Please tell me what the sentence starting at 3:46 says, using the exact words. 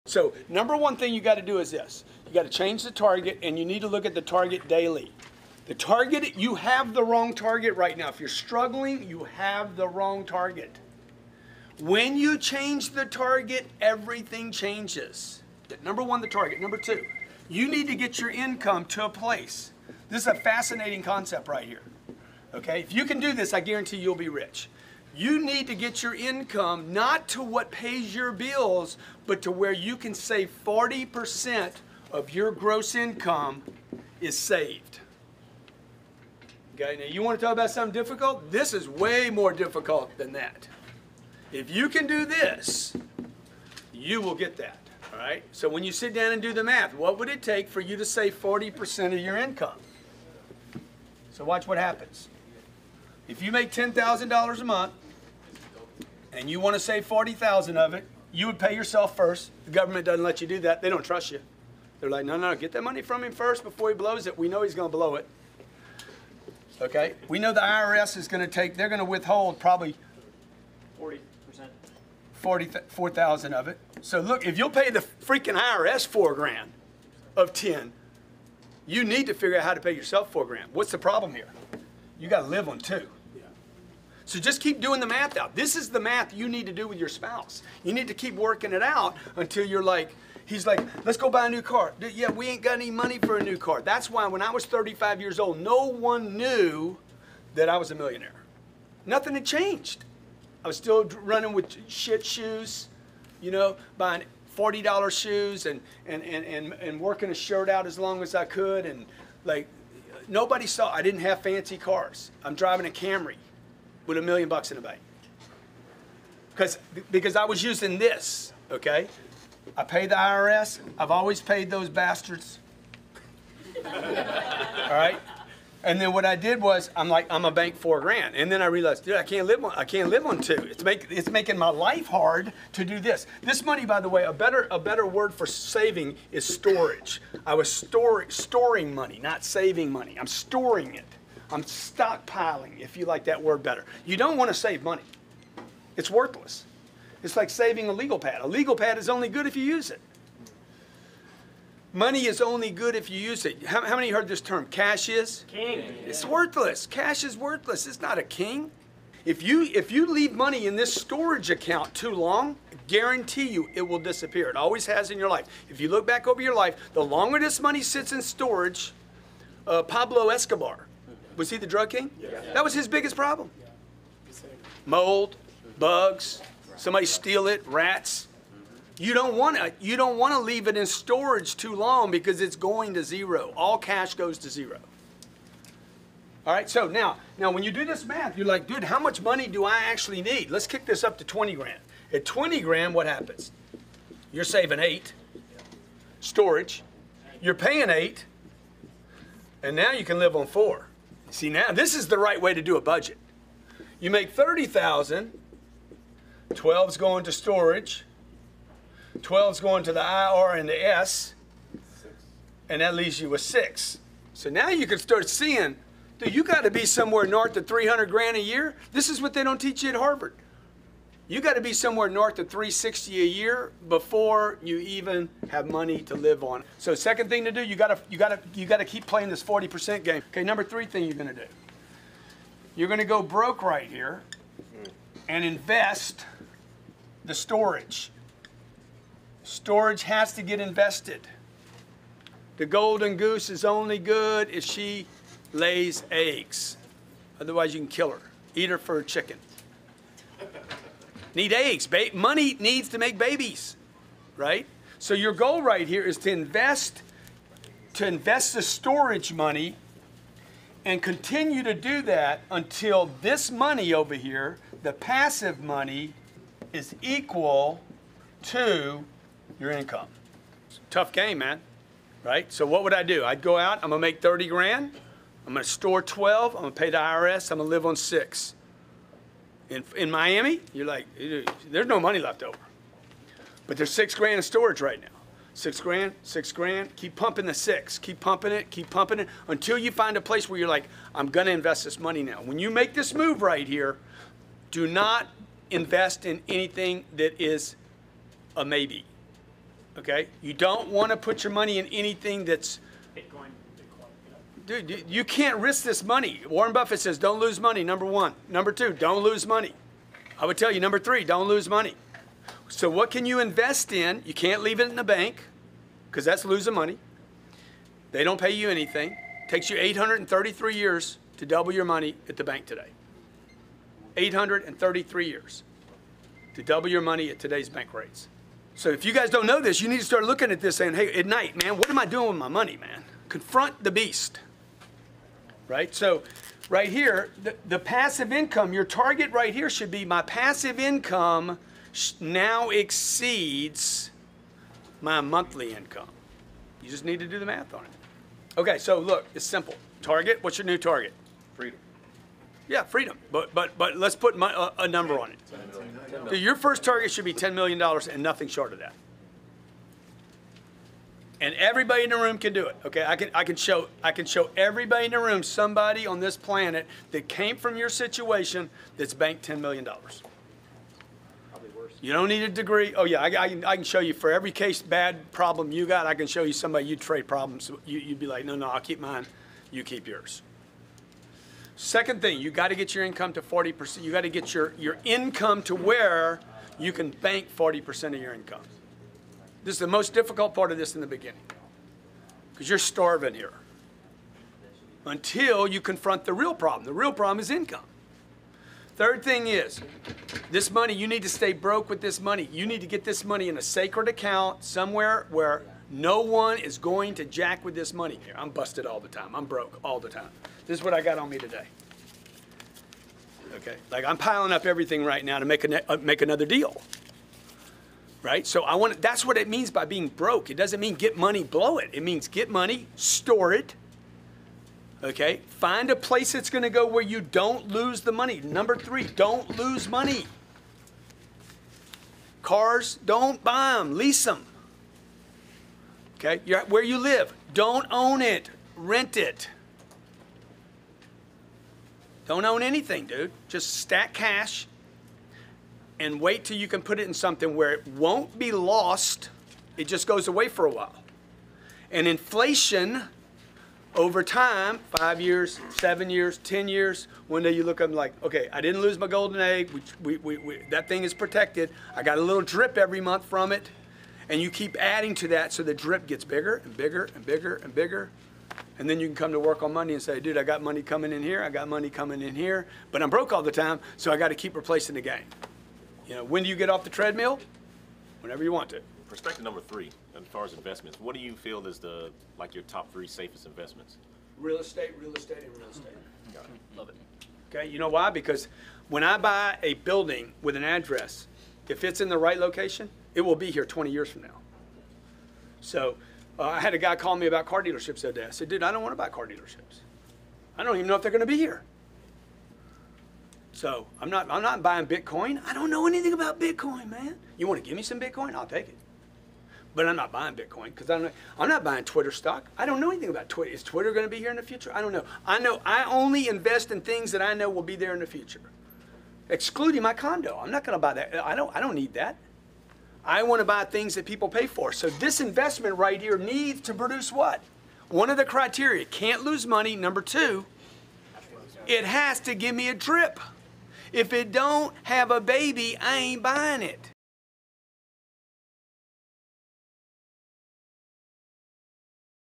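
So second thing to do, you got to you got to you got to keep playing this 40% game.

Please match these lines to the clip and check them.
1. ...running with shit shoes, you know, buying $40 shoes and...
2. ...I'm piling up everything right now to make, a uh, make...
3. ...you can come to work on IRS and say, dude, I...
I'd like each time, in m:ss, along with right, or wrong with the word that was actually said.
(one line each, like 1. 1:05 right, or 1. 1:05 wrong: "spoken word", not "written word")
1. 1:41 right
2. 6:54 right
3. 7:48 wrong: "Monday", not "IRS".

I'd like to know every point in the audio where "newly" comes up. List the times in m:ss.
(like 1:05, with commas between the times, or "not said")
not said.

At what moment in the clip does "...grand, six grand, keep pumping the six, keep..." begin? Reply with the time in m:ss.
4:45.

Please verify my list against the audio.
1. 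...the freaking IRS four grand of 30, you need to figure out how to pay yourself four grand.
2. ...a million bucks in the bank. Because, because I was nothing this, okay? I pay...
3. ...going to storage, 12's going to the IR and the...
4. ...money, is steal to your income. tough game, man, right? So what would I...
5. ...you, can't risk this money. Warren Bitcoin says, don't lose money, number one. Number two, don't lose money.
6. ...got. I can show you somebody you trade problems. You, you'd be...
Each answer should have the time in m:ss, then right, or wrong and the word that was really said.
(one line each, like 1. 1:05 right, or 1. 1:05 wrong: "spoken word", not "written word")
1. 1:14 wrong: "10", not "30"
2. 1:54 wrong: "using", not "nothing"
3. 3:26 right
4. 4:25 wrong: "equal", not "steal"
5. 5:05 wrong: "Buffett", not "Bitcoin"
6. 6:15 right.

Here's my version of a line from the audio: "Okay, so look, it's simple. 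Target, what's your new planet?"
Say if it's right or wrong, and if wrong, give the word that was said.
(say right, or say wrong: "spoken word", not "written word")
wrong: "target", not "planet".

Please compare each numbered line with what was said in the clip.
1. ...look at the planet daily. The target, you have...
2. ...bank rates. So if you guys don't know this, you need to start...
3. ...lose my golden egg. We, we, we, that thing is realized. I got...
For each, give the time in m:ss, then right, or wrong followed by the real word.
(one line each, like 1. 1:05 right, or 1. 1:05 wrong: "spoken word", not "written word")
1. 0:03 wrong: "target", not "planet"
2. 5:27 right
3. 7:38 wrong: "protected", not "realized".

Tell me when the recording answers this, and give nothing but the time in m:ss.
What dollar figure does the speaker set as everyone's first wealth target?
5:57.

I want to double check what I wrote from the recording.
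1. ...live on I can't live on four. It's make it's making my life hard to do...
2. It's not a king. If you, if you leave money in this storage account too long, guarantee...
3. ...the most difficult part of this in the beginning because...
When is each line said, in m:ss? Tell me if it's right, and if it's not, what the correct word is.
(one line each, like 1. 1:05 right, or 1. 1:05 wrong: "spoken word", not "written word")
1. 2:09 wrong: "two", not "four"
2. 2:37 right
3. 6:29 right.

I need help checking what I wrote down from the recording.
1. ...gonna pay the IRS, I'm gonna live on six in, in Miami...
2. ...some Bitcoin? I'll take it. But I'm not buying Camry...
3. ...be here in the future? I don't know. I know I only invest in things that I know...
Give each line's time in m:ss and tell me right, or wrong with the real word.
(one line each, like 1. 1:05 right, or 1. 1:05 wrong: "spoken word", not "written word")
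1. 4:36 right
2. 8:27 wrong: "Bitcoin", not "Camry"
3. 8:34 right.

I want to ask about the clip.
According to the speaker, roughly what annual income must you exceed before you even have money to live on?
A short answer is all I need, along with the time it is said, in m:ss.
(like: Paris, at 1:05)
360 a year, at 3:42.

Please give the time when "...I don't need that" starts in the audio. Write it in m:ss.
8:41.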